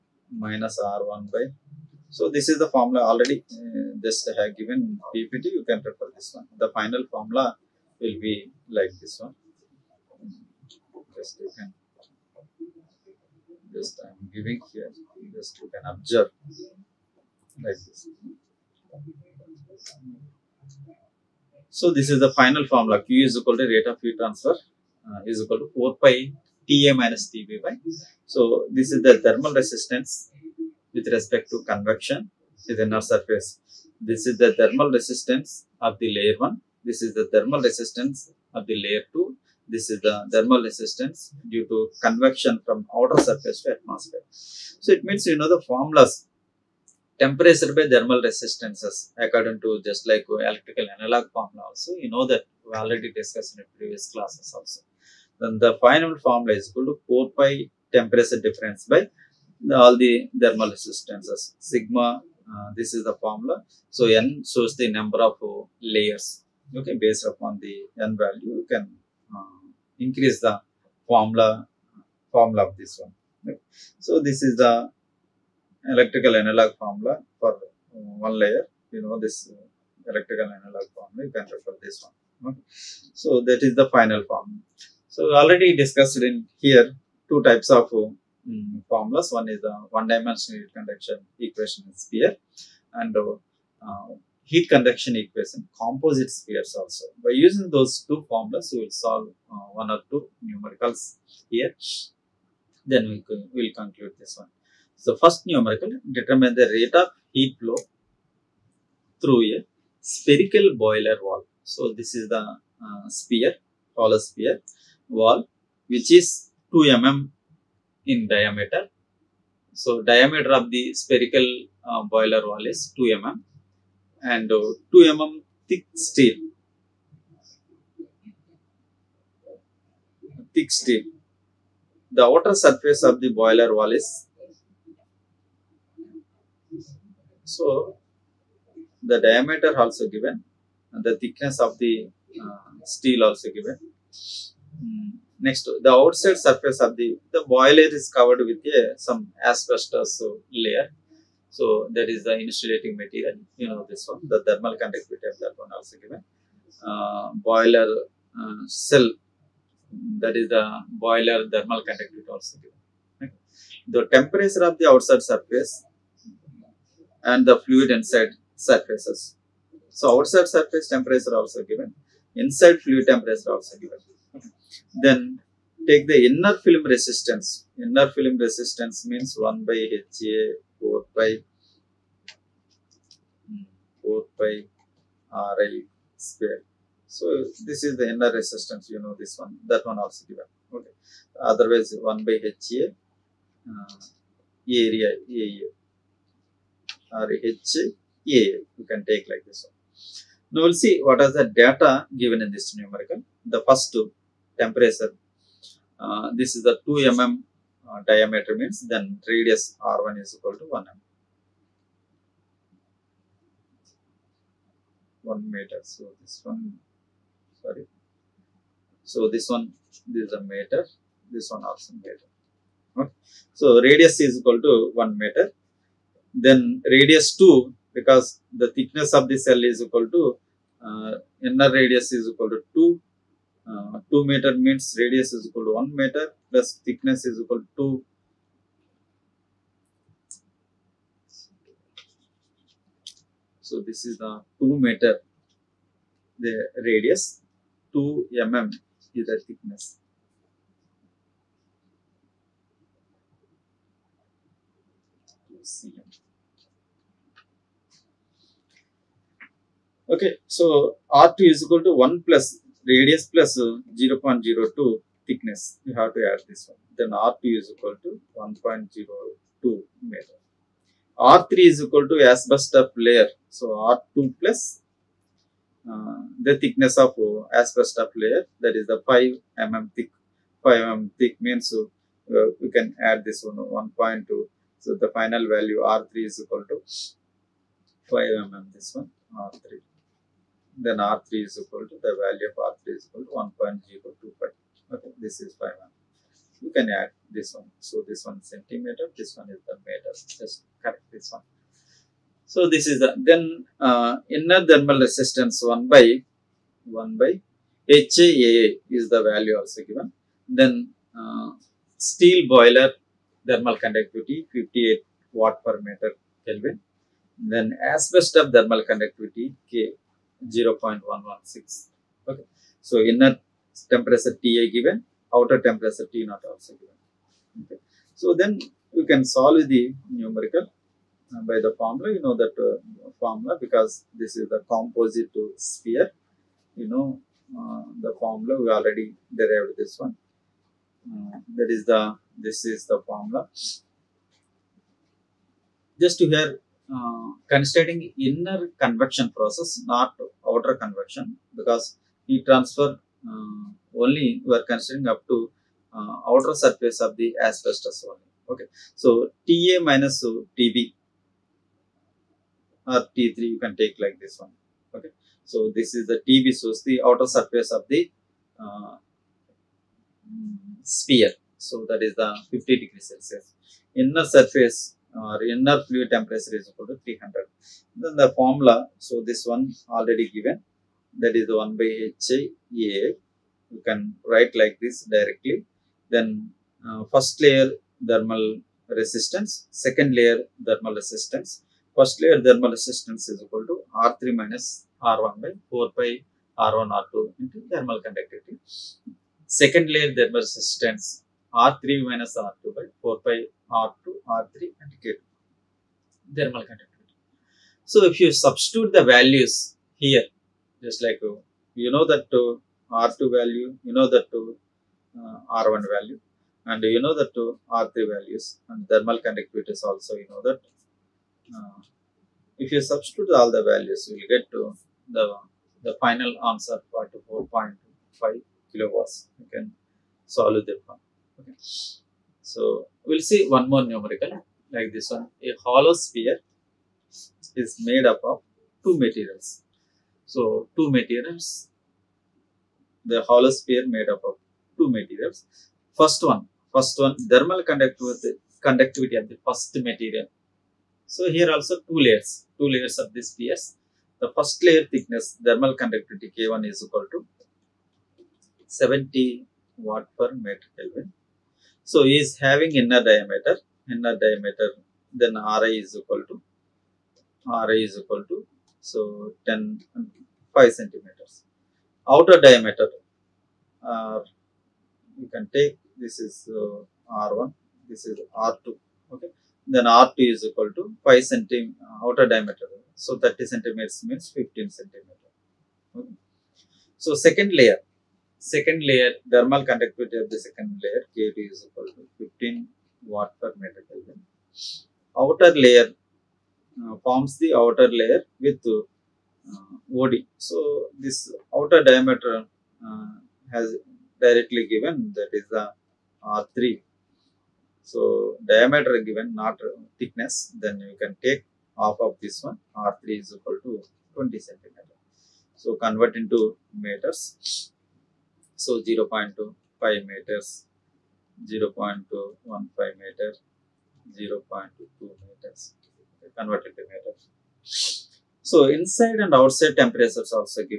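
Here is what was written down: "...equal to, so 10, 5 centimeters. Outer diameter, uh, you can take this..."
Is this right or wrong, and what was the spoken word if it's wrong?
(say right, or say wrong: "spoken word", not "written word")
right.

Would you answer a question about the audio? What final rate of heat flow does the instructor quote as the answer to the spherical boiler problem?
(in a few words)
4.5 kilowatts.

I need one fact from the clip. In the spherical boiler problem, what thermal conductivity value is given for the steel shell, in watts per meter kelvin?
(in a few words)
58.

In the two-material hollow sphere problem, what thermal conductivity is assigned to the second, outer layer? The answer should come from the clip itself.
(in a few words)
15 watt per meter Kelvin.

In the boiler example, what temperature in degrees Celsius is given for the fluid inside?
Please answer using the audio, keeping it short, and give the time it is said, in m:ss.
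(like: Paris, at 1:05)
300, at 6:17.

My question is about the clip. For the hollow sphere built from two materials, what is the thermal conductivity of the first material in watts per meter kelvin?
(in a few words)
70.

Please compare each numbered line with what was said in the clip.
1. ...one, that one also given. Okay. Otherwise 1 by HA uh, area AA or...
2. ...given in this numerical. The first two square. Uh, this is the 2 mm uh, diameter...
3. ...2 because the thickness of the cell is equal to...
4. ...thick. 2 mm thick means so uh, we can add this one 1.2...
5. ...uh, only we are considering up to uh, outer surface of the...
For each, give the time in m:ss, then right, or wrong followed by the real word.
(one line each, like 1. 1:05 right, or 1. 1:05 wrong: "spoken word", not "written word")
1. 3:09 right
2. 3:22 wrong: "temperature", not "square"
3. 3:47 right
4. 4:39 wrong: "5", not "2"
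5. 5:53 right.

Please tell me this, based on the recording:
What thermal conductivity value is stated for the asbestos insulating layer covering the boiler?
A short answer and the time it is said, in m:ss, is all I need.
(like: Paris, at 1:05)
0.116, at 5:20.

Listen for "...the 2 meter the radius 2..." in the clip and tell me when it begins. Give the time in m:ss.
4:04.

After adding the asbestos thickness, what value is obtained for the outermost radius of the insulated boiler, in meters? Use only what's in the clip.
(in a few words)
1.025.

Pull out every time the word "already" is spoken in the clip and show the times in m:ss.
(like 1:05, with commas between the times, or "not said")
0:03, 0:52, 1:25, 5:38, 6:19.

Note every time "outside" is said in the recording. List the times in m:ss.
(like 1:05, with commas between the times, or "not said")
2:25, 2:44, 2:50, 8:49.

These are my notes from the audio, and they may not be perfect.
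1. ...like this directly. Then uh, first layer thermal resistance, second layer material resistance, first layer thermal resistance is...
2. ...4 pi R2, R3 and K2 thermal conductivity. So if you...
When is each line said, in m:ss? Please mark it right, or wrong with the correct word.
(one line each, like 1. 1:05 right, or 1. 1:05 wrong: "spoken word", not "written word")
1. 6:24 wrong: "thermal", not "material"
2. 6:43 right.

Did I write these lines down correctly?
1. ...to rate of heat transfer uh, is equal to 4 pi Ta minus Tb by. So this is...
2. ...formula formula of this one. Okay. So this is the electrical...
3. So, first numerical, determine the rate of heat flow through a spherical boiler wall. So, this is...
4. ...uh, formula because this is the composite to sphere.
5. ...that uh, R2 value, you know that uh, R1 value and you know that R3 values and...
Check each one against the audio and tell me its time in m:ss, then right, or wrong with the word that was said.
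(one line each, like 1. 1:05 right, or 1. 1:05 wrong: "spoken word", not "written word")
1. 0:23 right
2. 1:11 right
3. 1:44 right
4. 5:32 right
5. 6:52 right.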